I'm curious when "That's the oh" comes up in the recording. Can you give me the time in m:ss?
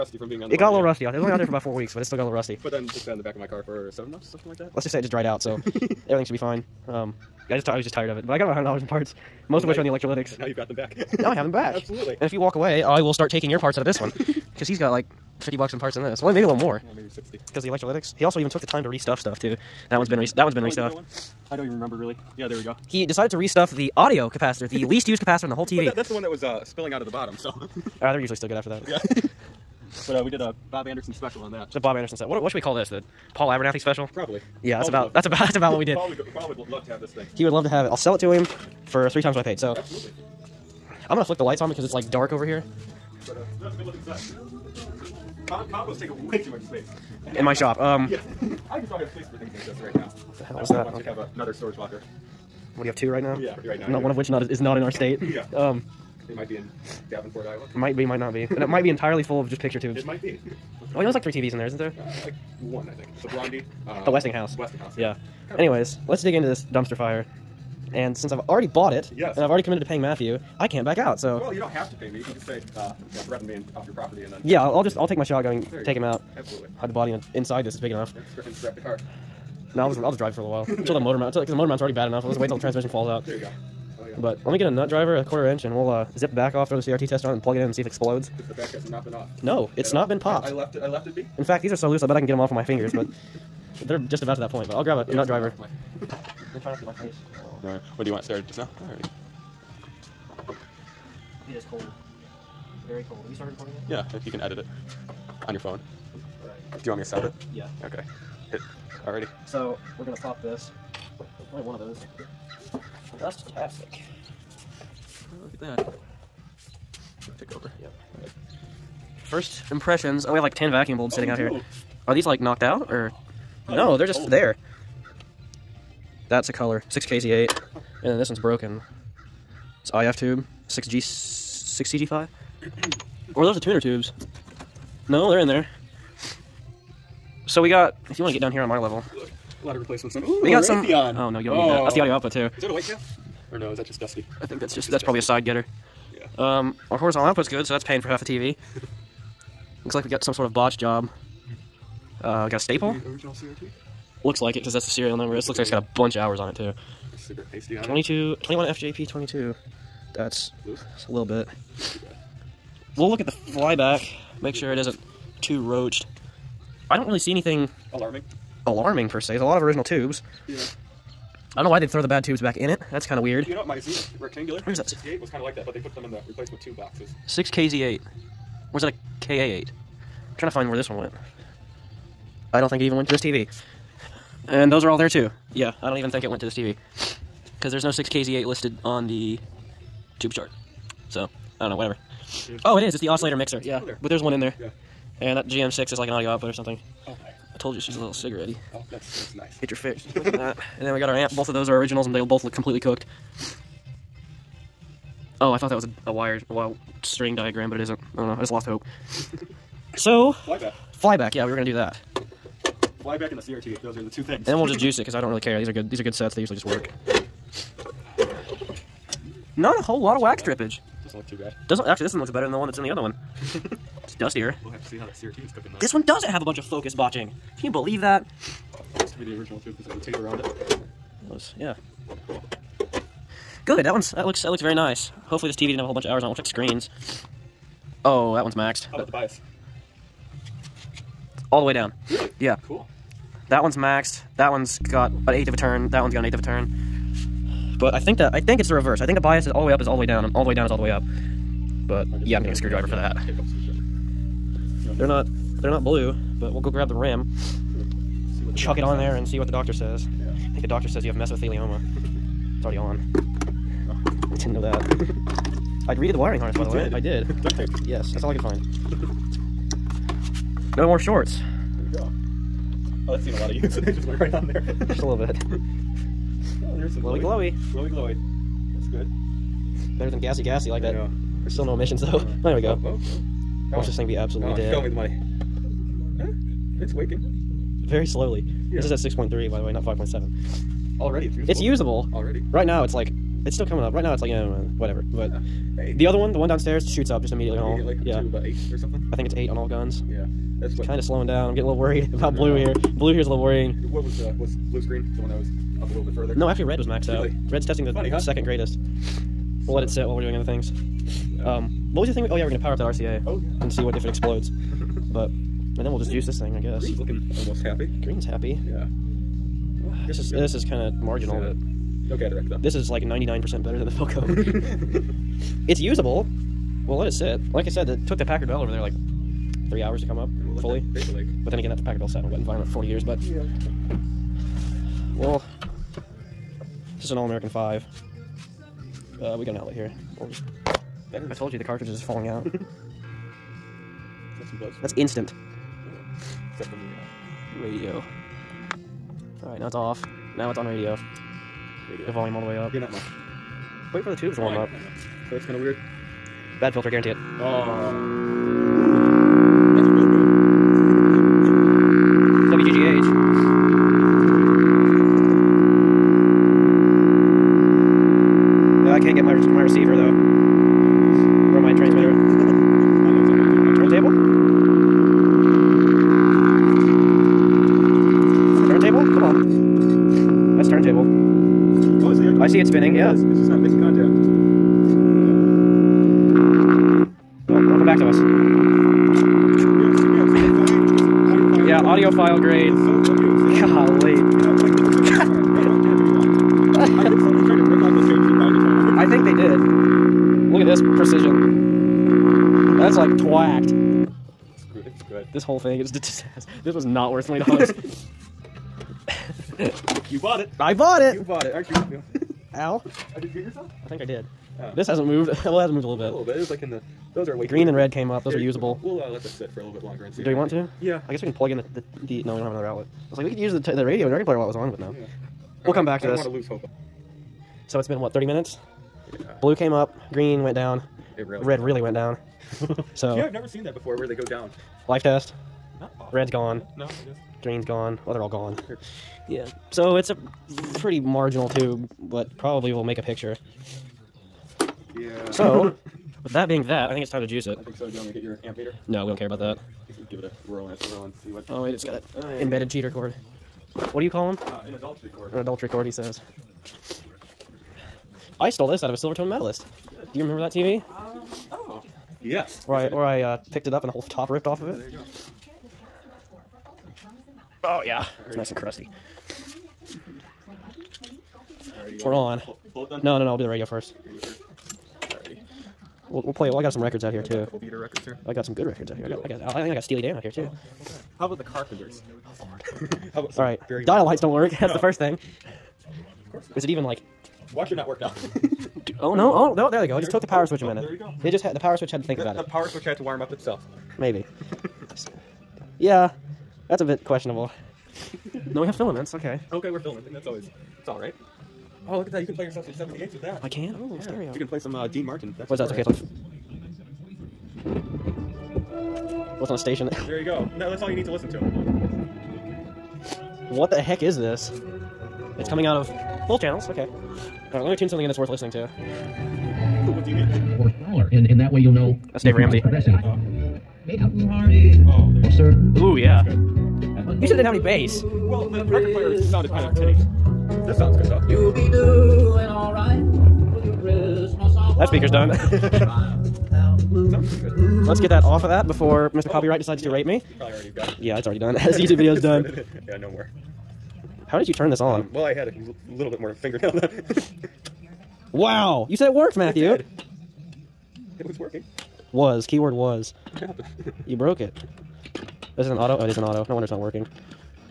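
2:21.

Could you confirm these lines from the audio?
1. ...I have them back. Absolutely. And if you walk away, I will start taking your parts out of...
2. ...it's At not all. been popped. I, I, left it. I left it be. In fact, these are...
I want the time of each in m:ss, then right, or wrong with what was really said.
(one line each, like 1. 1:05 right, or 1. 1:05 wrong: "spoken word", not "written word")
1. 0:11 right
2. 1:29 right.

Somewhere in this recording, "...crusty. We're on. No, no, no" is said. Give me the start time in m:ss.
7:48.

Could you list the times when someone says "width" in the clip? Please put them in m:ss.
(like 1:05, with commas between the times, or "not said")
not said.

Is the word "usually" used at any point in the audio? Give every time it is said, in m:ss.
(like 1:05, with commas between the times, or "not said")
0:28, 3:36.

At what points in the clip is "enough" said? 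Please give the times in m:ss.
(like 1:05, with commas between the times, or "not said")
1:17, 1:22.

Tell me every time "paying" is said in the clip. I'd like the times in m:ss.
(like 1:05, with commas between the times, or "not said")
1:09, 2:27.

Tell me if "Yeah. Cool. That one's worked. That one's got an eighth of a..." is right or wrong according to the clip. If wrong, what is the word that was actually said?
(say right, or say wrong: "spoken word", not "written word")
wrong: "maxed", not "worked".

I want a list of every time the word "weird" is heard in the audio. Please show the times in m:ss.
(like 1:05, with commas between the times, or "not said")
2:53, 5:55.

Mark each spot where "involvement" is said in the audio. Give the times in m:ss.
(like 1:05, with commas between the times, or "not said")
not said.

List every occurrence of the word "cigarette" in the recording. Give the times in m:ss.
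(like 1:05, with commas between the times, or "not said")
2:37, 3:18.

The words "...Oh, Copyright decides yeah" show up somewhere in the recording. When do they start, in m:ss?
8:59.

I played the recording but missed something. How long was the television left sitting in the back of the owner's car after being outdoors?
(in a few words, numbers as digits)
7 months.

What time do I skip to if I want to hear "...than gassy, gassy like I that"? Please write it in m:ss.
4:40.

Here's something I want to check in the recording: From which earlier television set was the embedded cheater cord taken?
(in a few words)
Silvertone Medalist.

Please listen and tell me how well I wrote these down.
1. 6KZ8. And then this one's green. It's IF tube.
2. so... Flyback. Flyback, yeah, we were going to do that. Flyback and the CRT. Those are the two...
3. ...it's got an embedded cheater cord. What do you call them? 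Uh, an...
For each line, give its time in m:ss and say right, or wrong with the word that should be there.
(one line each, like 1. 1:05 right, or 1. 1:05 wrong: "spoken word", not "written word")
1. 2:06 wrong: "broken", not "green"
2. 3:29 right
3. 7:31 right.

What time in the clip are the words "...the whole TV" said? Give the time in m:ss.
0:25.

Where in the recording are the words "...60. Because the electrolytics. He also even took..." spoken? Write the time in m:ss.
0:17.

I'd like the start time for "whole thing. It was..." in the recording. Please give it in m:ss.
6:45.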